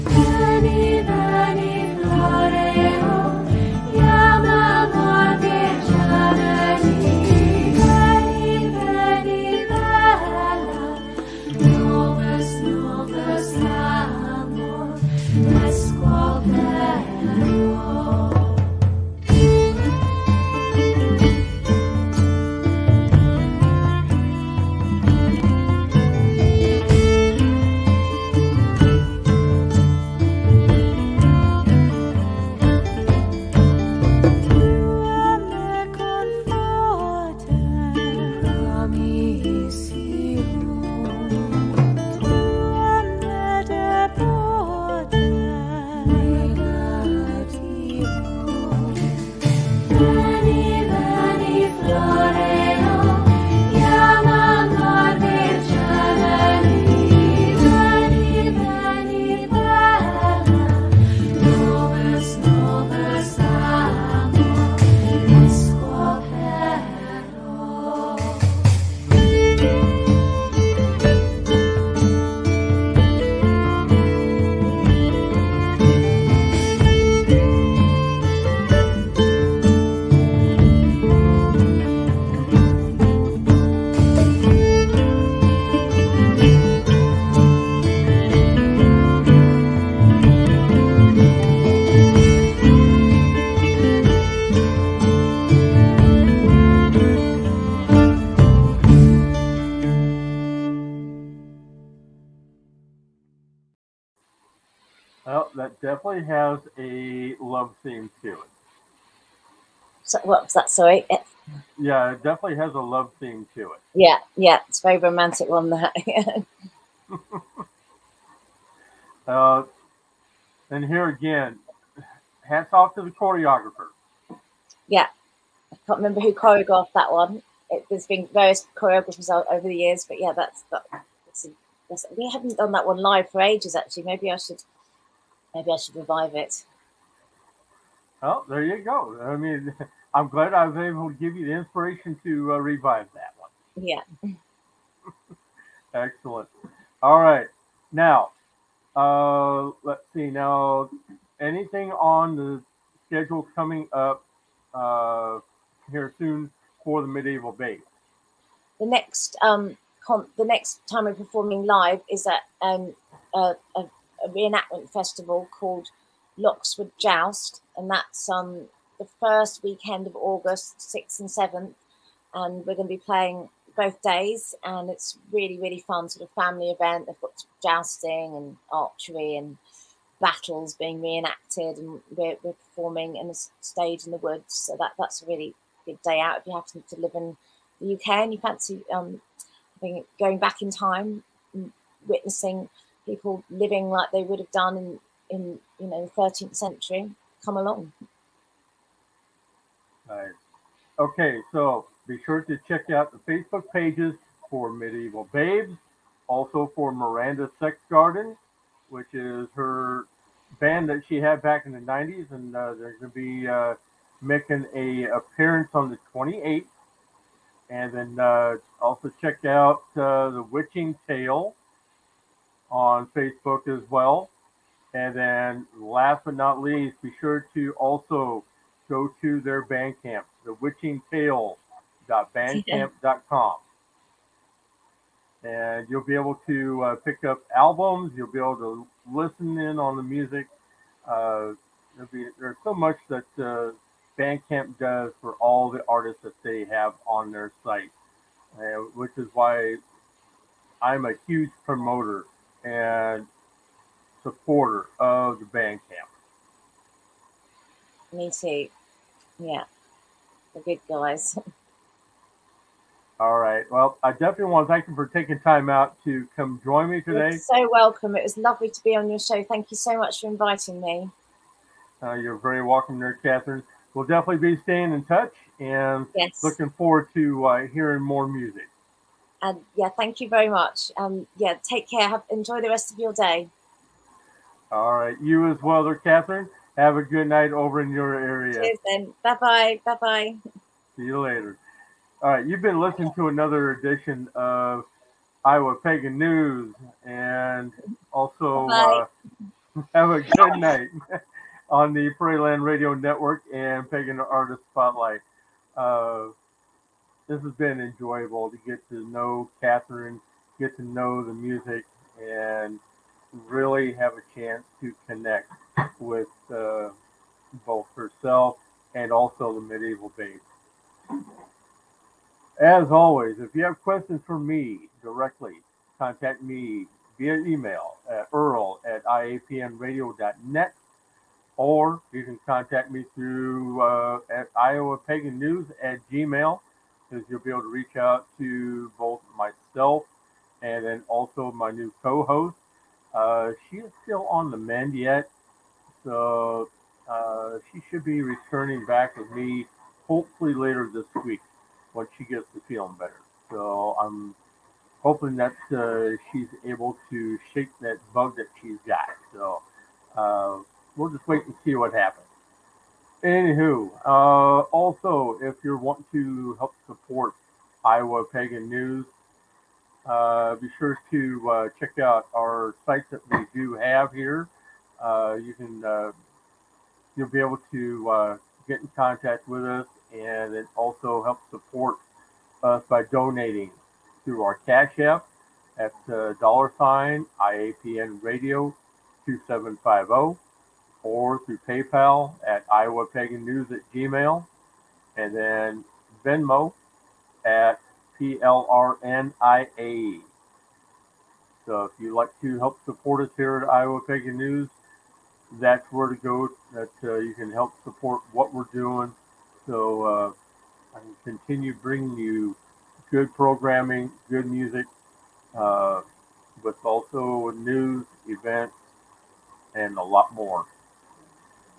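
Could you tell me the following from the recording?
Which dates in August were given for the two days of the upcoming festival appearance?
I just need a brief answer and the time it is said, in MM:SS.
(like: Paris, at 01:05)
6th and 7th, at 02:50.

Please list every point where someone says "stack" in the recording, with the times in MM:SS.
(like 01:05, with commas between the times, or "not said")
not said.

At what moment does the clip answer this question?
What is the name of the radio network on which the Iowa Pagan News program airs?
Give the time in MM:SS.
05:02.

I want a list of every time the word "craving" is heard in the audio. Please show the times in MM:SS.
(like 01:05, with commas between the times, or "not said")
not said.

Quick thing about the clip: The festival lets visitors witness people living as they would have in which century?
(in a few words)
13th century.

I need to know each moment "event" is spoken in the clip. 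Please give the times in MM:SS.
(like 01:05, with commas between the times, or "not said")
02:56, 06:58.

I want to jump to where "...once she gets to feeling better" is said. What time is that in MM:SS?
05:51.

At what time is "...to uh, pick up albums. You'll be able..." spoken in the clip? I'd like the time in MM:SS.
03:56.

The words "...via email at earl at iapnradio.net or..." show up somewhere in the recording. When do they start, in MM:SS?
05:27.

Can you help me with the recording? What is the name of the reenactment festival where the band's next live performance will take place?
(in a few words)
Loxwood Joust.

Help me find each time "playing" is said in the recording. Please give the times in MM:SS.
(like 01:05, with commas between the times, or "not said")
02:52.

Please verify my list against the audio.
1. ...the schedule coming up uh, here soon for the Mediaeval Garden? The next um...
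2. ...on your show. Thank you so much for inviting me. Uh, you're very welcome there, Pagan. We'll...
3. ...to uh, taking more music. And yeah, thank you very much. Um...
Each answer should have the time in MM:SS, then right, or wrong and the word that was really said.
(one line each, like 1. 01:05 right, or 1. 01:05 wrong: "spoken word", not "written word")
1. 02:32 wrong: "Baebes", not "Garden"
2. 04:28 wrong: "Katharine", not "Pagan"
3. 04:37 wrong: "hearing", not "taking".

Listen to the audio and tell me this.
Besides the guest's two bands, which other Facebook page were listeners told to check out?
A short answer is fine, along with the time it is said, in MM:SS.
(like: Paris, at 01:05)
The Witching Tale, at 03:40.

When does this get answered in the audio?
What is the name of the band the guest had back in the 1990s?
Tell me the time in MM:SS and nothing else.
03:26.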